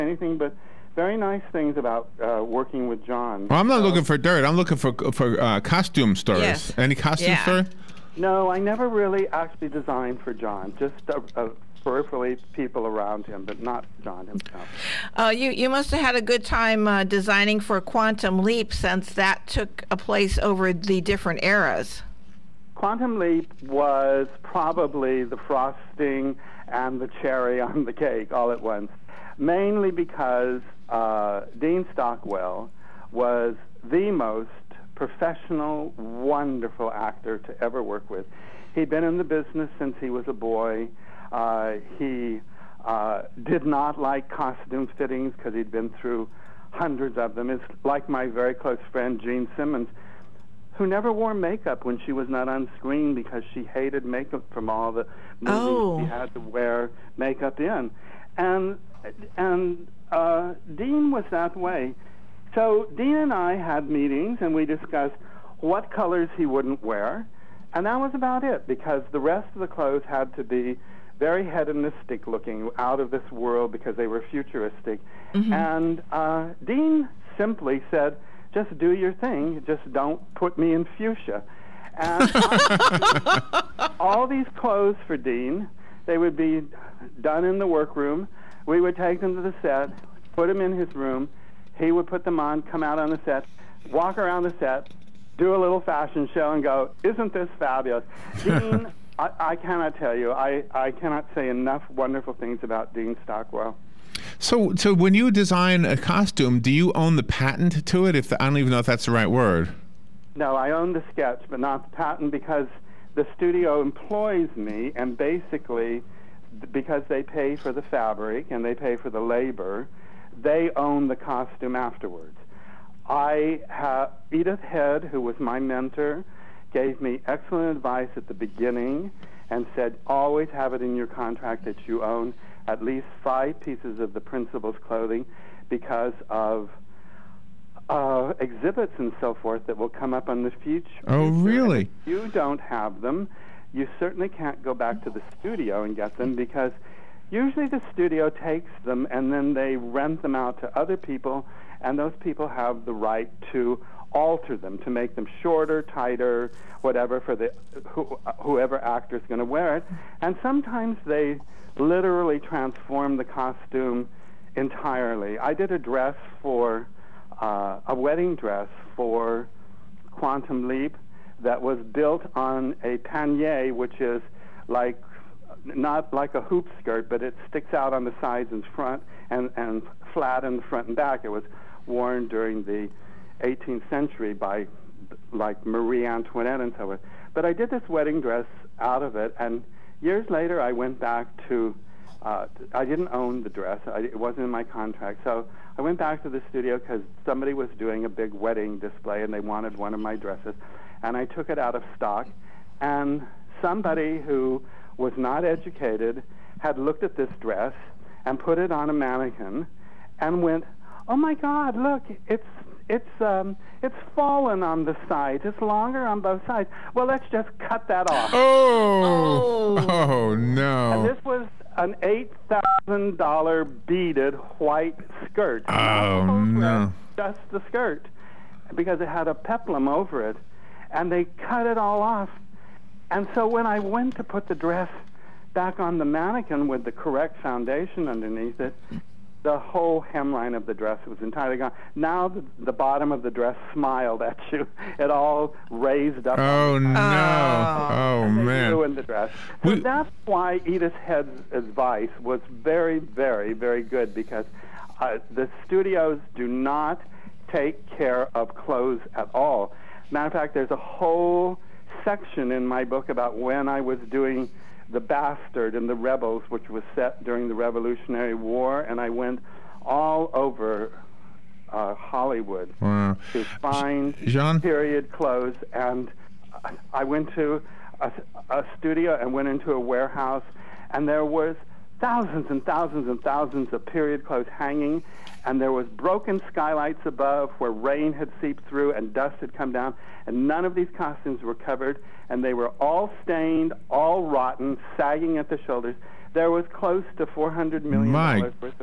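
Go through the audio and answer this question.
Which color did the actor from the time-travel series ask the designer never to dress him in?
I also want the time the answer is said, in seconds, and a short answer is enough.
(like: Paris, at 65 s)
Fuchsia, at 80 s.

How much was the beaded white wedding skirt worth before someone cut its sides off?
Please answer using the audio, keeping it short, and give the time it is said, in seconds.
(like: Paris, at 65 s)
$8,000, at 222 s.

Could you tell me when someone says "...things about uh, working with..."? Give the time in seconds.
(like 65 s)
1 s.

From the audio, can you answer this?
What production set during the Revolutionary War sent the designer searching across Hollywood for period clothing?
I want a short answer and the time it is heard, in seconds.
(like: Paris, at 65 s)
The Bastard and the Rebels, at 264 s.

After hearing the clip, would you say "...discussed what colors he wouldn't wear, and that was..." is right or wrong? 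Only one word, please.
right.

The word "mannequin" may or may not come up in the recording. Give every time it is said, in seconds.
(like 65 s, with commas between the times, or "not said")
208 s, 236 s.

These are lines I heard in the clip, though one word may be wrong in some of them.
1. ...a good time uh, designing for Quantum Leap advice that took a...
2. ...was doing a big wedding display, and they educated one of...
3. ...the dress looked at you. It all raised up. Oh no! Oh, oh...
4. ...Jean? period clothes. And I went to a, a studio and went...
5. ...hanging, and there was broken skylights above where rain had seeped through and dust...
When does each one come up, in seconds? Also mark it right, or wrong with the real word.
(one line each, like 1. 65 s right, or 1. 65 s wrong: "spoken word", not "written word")
1. 16 s wrong: "since", not "advice"
2. 197 s wrong: "wanted", not "educated"
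3. 243 s wrong: "smiled", not "looked"
4. 274 s right
5. 284 s right.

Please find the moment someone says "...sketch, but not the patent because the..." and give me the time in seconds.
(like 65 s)
111 s.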